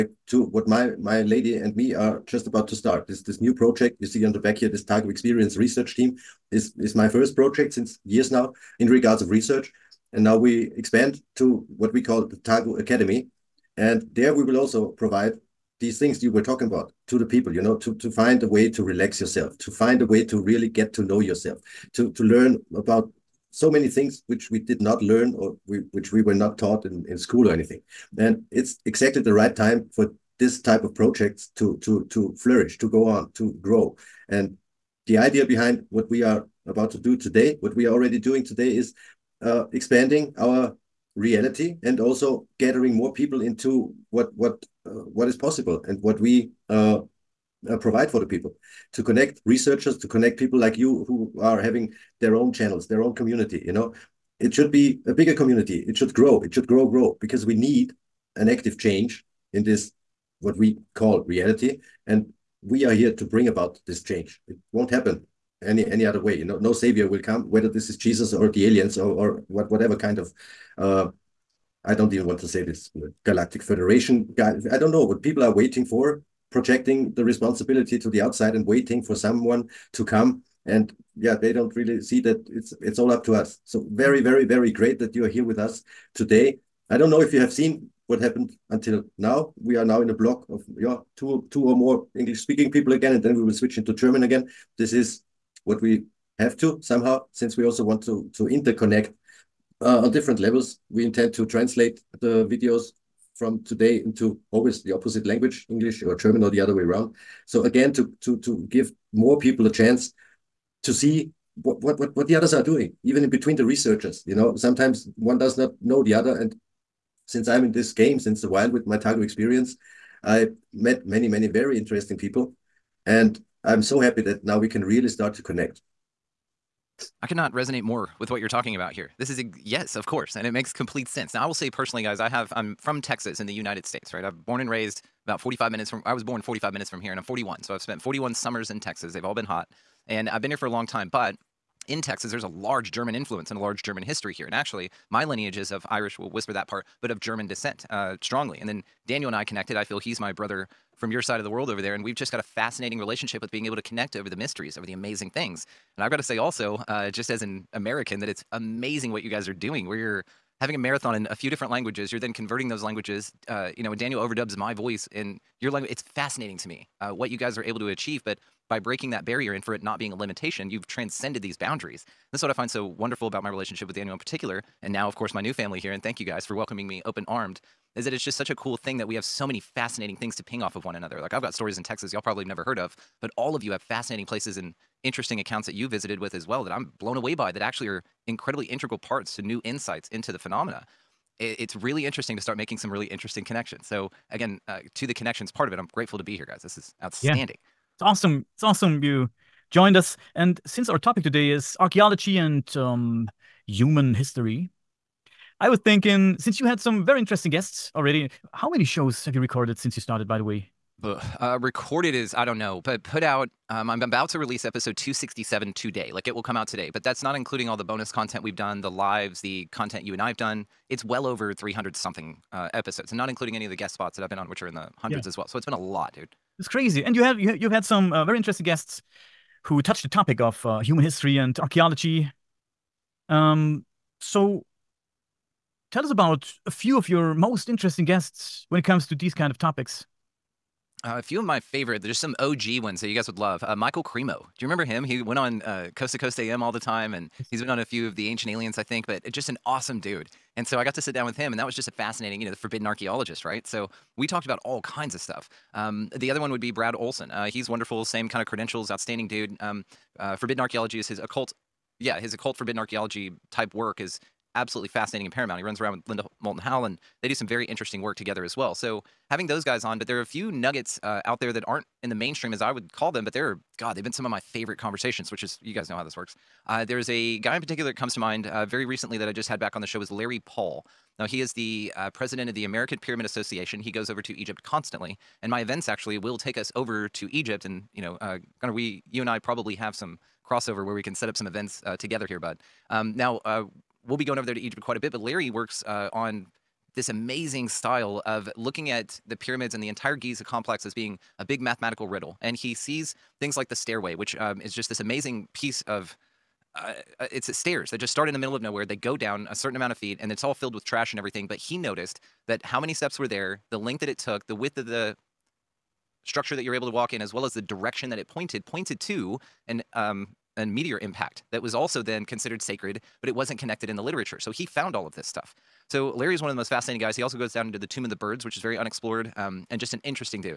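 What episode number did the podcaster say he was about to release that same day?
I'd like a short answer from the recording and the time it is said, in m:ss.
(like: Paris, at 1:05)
267, at 3:34.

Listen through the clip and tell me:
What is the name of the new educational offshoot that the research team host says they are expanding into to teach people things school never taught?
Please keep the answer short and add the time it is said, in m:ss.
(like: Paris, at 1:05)
Tagu Academy, at 0:12.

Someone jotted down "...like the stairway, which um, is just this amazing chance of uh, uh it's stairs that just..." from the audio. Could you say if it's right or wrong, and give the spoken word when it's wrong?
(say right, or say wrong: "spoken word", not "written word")
wrong: "piece", not "chance".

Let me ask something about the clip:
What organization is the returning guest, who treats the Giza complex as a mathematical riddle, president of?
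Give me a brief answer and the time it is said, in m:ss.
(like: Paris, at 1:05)
American Pyramid Association, at 4:42.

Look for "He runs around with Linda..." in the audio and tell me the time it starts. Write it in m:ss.
4:25.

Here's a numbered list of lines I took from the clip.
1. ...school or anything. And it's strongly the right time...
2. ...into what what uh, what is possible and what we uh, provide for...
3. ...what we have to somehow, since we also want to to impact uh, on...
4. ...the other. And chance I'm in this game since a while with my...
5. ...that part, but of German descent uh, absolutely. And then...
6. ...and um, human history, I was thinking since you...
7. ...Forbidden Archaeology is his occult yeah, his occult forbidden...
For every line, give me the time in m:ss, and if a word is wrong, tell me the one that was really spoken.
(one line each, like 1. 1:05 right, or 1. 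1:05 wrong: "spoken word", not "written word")
1. 0:27 wrong: "exactly", not "strongly"
2. 0:43 right
3. 1:35 wrong: "interconnect", not "impact"
4. 1:56 wrong: "since", not "chance"
5. 2:26 wrong: "strongly", not "absolutely"
6. 3:22 right
7. 4:20 right.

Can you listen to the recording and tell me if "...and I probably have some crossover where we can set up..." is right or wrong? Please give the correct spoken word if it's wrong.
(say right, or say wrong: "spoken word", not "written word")
right.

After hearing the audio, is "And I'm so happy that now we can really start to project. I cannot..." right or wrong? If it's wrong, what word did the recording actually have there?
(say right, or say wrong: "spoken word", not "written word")
wrong: "connect", not "project".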